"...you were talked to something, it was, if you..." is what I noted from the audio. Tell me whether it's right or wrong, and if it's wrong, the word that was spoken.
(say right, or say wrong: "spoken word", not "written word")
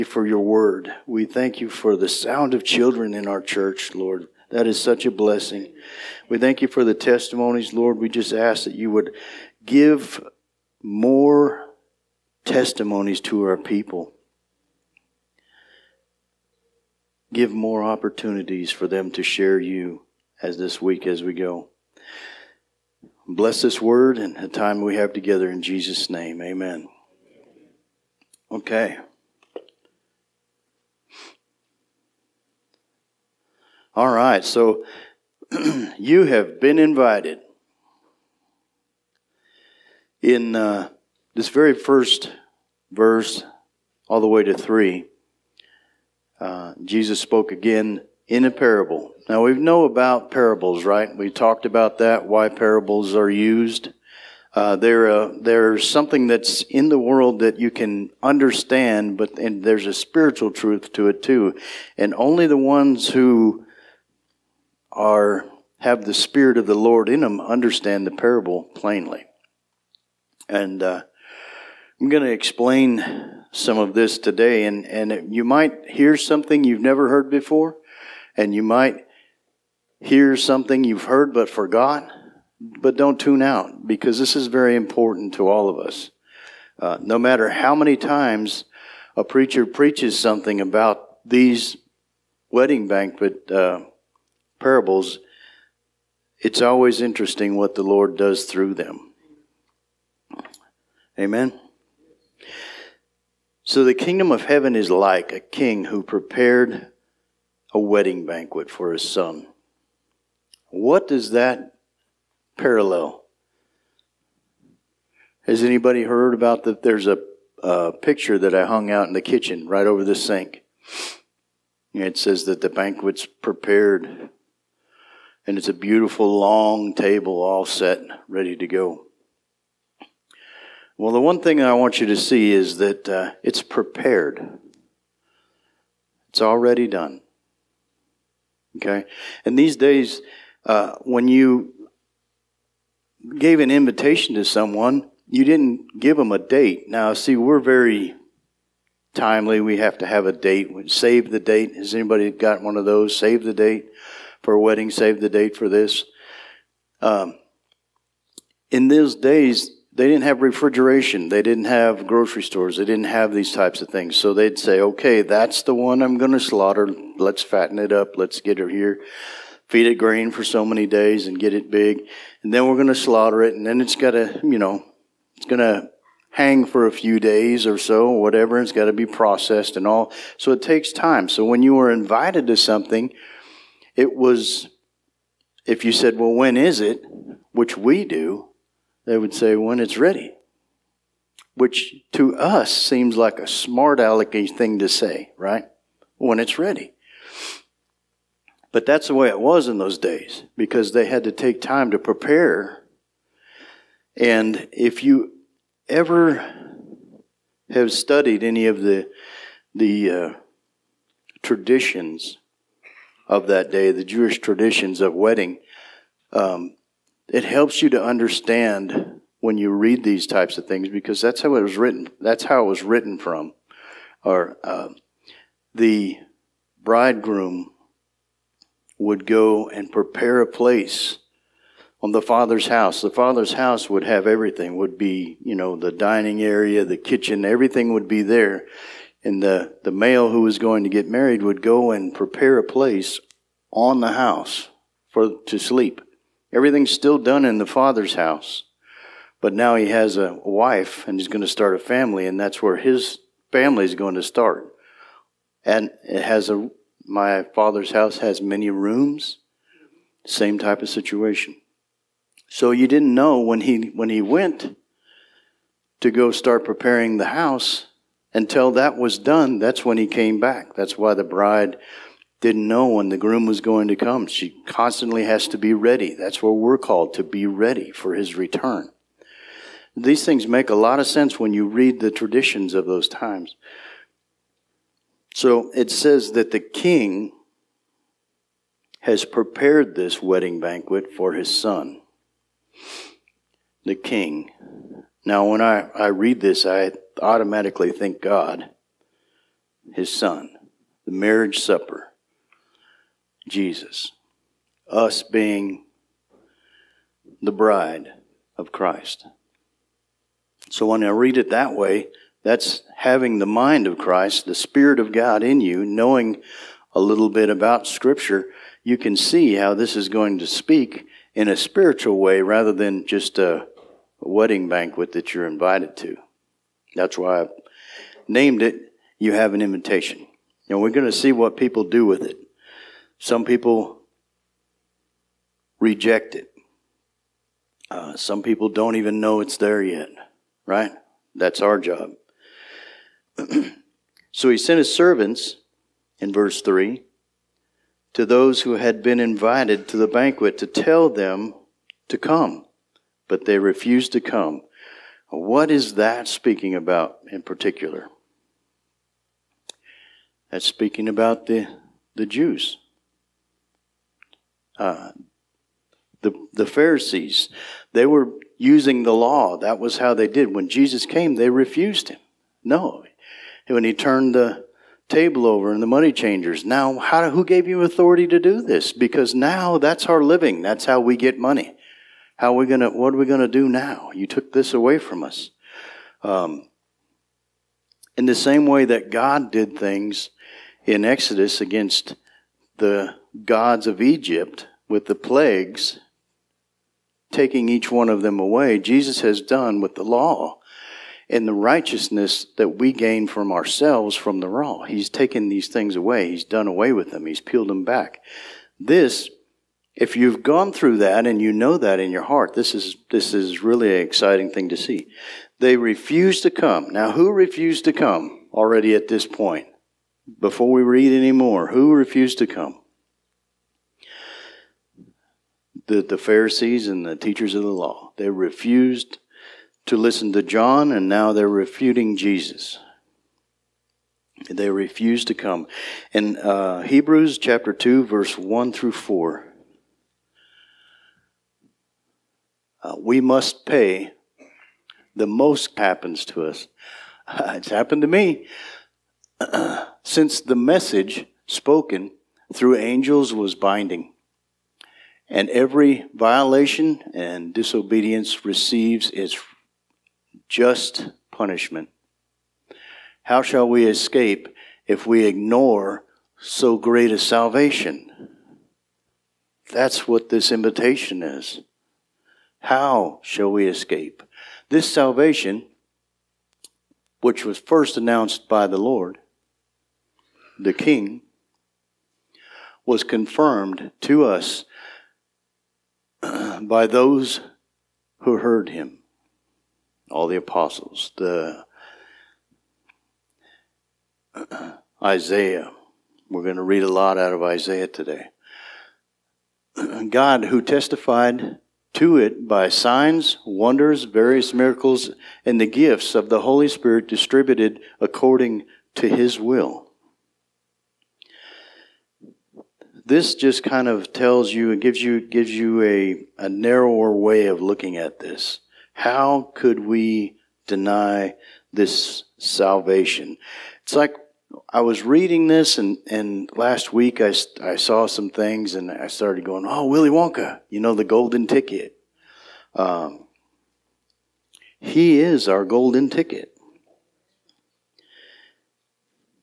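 wrong: "invited", not "talked".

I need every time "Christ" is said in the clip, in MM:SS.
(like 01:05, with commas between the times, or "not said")
05:08, 05:13.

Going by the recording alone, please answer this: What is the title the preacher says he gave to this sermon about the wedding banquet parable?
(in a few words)
You Have an Invitation.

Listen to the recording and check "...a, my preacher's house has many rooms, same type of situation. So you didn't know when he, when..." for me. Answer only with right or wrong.
wrong.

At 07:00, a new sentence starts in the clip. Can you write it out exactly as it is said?
Before we read any more, who refused to come?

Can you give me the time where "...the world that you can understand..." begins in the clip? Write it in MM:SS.
00:56.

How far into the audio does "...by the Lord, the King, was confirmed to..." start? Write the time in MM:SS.
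07:58.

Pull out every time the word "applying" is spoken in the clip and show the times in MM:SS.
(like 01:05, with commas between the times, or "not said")
not said.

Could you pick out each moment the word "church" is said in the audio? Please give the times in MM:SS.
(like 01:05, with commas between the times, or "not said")
00:03.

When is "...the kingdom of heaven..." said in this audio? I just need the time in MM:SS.
01:43.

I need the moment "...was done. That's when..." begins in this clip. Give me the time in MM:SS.
04:28.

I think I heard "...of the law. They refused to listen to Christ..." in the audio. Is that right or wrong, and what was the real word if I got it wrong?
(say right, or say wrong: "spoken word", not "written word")
wrong: "John", not "Christ".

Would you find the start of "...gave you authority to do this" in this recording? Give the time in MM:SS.
06:17.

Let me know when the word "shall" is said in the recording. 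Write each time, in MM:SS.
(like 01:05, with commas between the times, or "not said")
07:43, 07:53.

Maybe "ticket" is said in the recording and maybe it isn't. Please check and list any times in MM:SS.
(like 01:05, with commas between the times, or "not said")
08:51, 08:56.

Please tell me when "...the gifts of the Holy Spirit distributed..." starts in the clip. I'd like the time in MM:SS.
08:25.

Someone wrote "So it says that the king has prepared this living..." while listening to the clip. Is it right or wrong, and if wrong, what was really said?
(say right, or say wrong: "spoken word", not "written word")
wrong: "wedding", not "living".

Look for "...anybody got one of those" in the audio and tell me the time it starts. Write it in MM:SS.
02:31.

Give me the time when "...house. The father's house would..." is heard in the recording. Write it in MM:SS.
03:52.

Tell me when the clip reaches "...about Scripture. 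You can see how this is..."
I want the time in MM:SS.
05:17.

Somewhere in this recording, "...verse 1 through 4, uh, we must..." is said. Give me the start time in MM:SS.
07:18.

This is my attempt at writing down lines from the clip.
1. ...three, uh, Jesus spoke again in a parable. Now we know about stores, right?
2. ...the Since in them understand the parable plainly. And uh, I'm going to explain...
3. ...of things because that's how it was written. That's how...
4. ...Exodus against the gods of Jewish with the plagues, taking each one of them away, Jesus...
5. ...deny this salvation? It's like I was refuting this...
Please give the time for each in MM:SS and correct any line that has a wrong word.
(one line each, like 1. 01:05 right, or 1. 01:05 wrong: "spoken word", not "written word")
1. 00:44 wrong: "parables", not "stores"
2. 01:06 wrong: "Lord", not "Since"
3. 03:40 right
4. 06:31 wrong: "Egypt", not "Jewish"
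5. 08:40 wrong: "reading", not "refuting".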